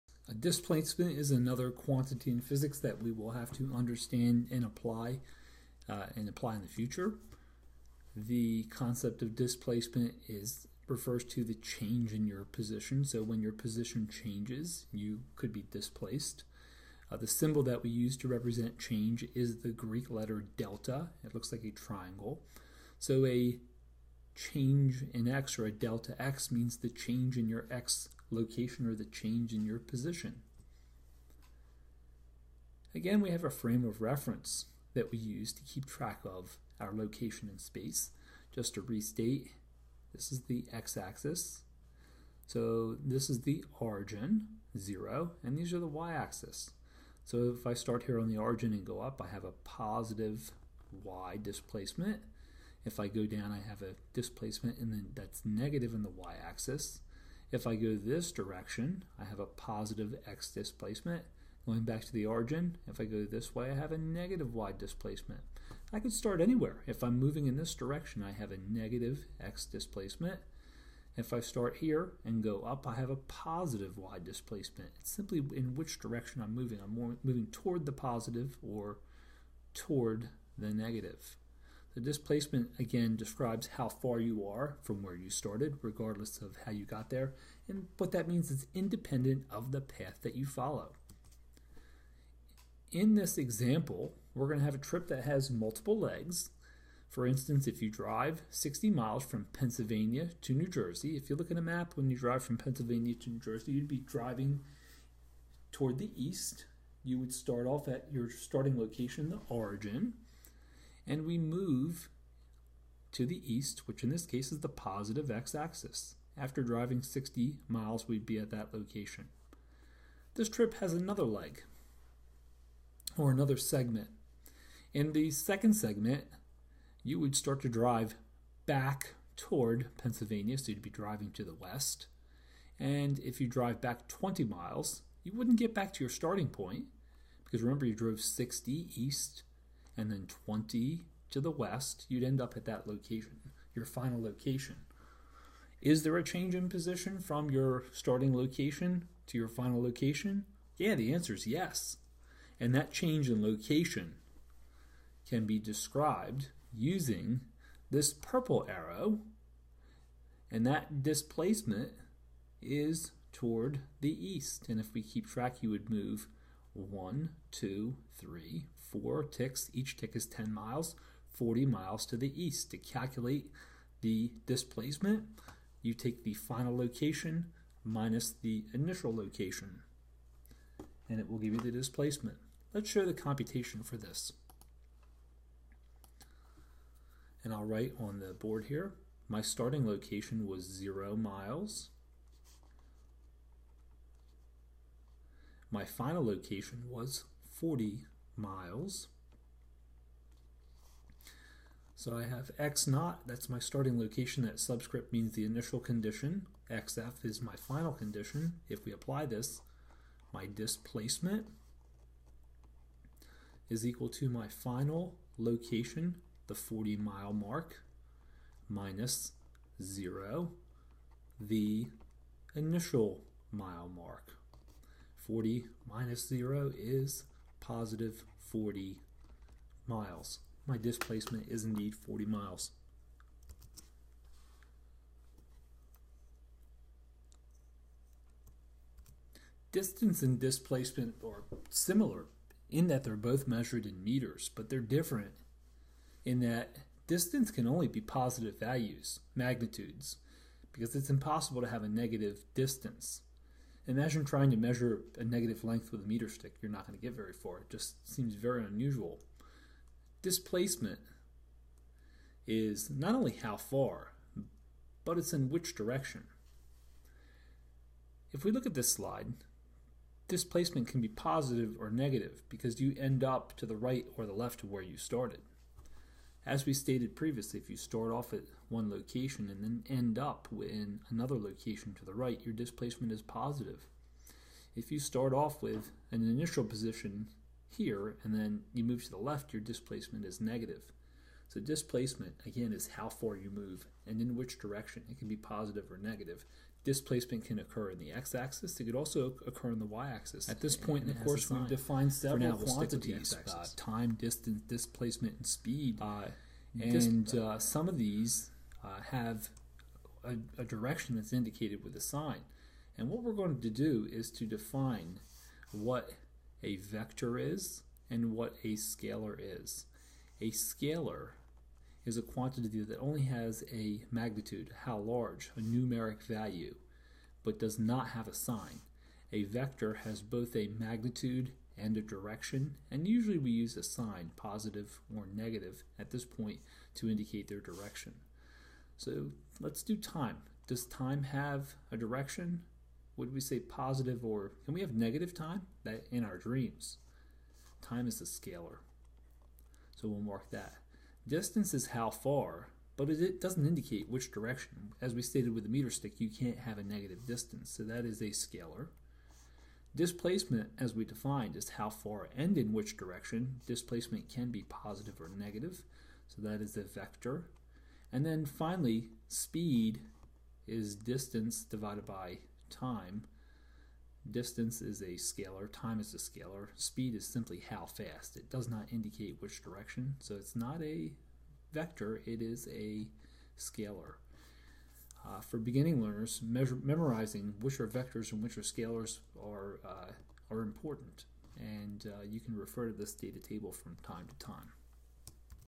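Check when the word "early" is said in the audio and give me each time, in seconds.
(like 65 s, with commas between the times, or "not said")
not said.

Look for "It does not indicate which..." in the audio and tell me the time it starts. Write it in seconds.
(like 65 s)
378 s.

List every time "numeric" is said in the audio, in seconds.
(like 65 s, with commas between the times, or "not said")
325 s.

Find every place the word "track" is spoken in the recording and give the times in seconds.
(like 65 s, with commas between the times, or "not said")
35 s, 165 s.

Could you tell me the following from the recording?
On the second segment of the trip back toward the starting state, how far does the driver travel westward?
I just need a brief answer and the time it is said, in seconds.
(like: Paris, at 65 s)
20 miles, at 134 s.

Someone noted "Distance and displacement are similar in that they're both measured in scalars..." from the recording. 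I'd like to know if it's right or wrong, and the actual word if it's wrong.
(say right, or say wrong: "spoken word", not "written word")
wrong: "meters", not "scalars".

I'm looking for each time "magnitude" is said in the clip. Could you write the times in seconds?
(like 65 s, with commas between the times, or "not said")
249 s, 324 s, 330 s.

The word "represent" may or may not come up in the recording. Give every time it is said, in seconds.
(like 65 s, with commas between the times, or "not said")
18 s.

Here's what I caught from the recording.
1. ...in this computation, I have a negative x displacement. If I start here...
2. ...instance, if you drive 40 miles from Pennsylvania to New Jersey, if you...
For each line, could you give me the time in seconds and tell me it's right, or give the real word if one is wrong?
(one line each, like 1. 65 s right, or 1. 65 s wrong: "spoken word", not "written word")
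1. 67 s wrong: "direction", not "computation"
2. 97 s wrong: "60", not "40".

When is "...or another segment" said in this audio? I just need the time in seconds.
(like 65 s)
123 s.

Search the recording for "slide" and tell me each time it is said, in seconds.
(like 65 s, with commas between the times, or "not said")
268 s.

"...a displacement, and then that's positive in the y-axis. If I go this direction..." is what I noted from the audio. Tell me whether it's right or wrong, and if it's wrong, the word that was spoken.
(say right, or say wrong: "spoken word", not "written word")
wrong: "negative", not "positive".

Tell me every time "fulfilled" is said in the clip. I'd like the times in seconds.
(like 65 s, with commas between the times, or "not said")
not said.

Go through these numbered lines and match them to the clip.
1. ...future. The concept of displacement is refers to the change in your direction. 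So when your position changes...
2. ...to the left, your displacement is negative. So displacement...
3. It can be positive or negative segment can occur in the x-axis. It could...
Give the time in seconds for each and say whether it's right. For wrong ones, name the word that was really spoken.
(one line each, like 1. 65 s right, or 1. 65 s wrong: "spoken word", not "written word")
1. 6 s wrong: "position", not "direction"
2. 289 s right
3. 295 s wrong: "displacement", not "segment".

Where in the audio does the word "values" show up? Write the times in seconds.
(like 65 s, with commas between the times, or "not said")
248 s, 326 s.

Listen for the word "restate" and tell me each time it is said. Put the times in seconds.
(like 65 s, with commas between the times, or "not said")
38 s.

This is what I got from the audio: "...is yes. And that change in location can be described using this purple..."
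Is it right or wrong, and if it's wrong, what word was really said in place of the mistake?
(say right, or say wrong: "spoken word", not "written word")
right.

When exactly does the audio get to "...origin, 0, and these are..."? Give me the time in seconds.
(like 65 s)
43 s.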